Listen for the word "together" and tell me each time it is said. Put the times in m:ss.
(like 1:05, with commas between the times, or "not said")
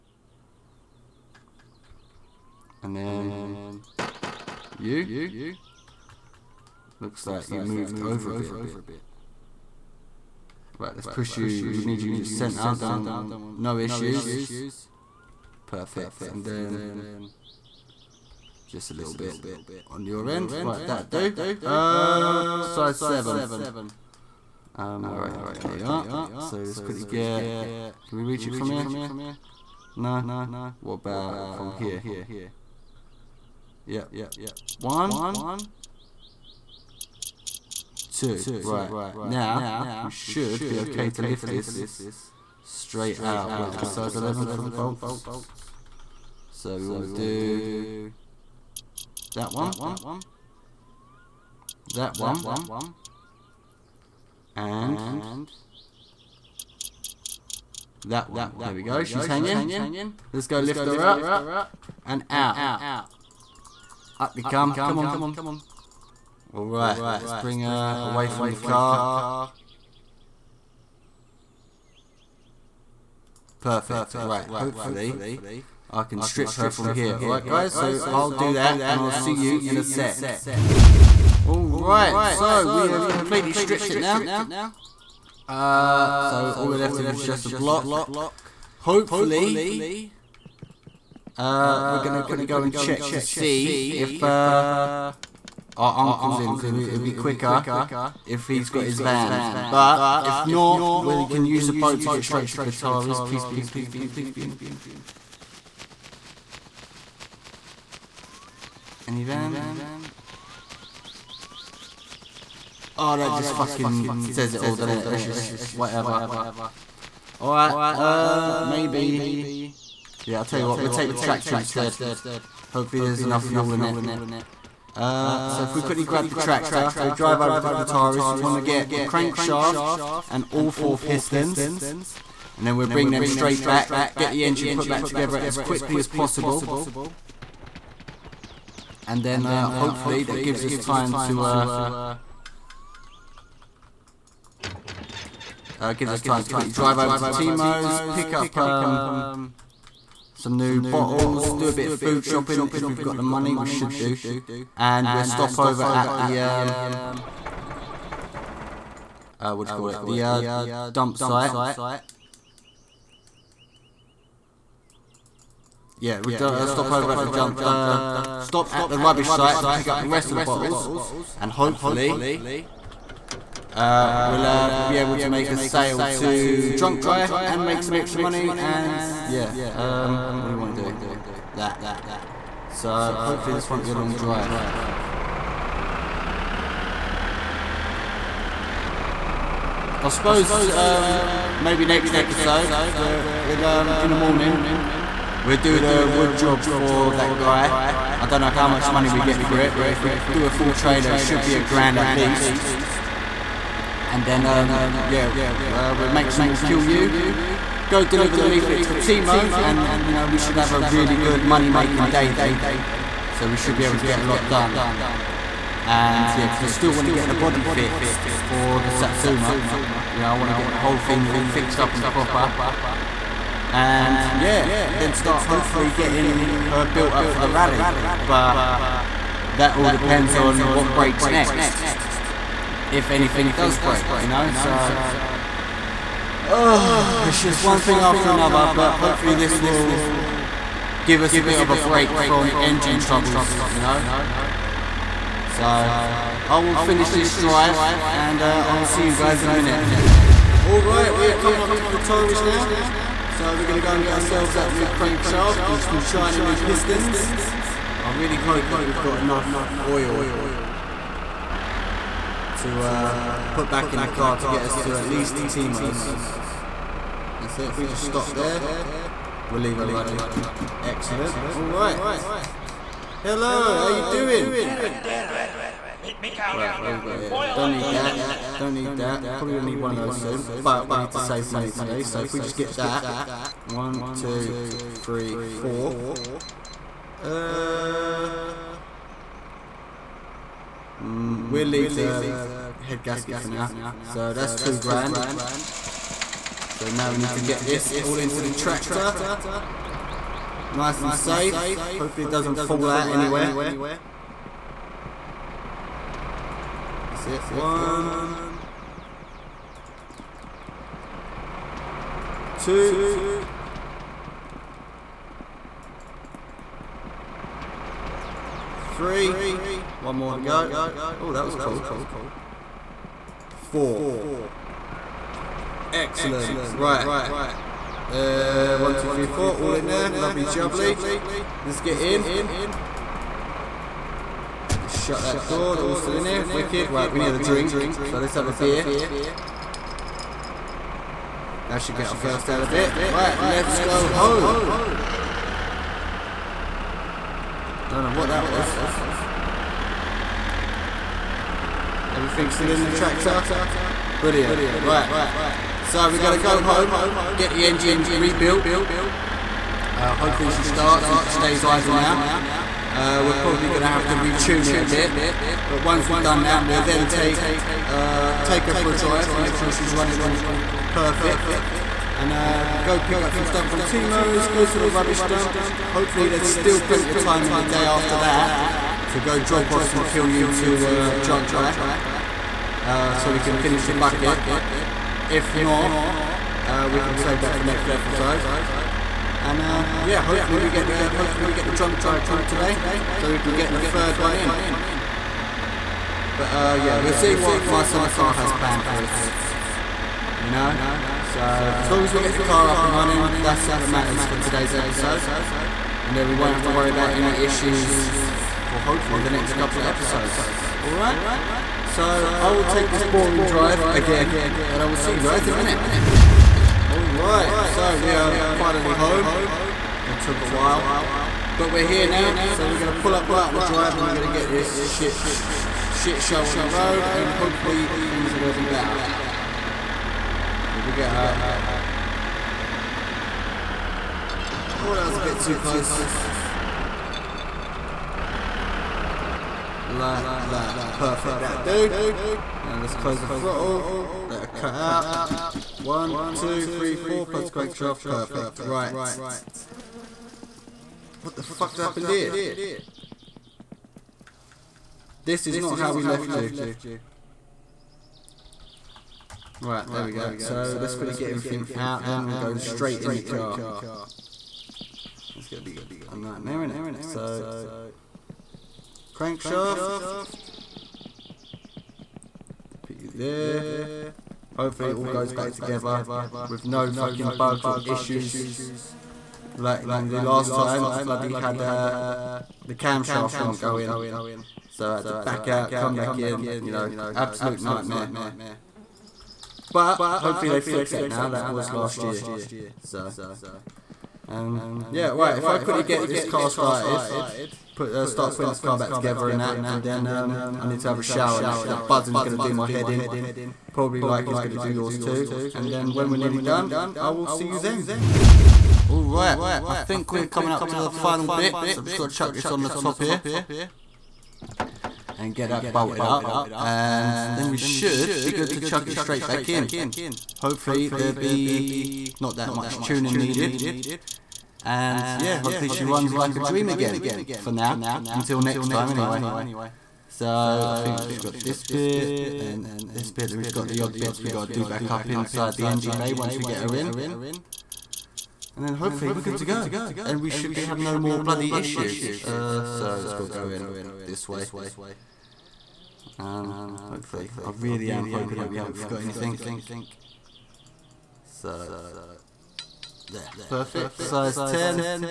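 2:15, 7:55, 8:18.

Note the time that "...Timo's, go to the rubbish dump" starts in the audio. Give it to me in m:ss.
6:13.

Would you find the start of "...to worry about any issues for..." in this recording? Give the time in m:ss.
6:46.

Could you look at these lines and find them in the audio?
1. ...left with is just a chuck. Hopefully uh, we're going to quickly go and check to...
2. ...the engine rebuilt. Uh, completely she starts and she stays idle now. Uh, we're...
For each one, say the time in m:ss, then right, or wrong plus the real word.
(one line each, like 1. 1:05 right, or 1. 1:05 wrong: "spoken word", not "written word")
1. 1:26 wrong: "block", not "chuck"
2. 5:57 wrong: "hopefully", not "completely".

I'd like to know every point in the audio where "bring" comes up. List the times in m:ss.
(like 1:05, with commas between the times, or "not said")
1:07, 2:12.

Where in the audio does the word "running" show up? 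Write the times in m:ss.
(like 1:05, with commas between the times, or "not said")
4:29, 6:09, 6:42.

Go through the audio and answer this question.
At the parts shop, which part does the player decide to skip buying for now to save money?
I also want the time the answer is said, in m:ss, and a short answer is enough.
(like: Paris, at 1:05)
Head gasket, at 4:52.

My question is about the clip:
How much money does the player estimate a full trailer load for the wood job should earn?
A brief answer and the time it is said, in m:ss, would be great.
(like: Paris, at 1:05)
A grand, at 3:21.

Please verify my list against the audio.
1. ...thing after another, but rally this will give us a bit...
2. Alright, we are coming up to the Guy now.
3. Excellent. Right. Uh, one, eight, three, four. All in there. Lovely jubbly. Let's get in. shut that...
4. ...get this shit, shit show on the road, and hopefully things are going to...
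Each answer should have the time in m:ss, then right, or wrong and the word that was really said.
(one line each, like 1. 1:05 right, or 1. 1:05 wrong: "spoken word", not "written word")
1. 3:57 wrong: "hopefully", not "rally"
2. 4:10 wrong: "Torres", not "Guy"
3. 5:25 wrong: "two", not "eight"
4. 7:04 right.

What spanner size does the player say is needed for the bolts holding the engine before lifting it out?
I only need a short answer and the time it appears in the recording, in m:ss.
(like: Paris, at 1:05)
11, at 0:43.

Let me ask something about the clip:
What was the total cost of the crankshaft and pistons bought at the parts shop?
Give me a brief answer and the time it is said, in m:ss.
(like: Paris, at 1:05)
Two grand, at 4:54.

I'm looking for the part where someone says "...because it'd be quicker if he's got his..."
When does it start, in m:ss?
1:36.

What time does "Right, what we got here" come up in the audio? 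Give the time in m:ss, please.
4:34.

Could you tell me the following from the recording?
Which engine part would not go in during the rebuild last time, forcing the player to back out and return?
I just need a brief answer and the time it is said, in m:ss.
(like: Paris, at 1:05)
Camshaft, at 8:02.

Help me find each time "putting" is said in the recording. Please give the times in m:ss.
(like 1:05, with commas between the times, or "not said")
8:18.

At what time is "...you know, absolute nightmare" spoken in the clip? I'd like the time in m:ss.
8:06.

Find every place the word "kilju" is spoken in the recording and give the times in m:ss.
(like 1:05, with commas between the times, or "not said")
3:26, 6:20.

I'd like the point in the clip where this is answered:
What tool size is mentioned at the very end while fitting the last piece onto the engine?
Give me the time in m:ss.
9:14.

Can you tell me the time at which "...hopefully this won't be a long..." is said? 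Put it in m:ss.
3:03.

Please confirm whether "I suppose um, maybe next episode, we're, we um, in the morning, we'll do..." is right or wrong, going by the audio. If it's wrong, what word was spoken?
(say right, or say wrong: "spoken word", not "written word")
right.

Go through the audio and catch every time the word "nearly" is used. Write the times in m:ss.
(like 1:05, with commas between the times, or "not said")
8:26.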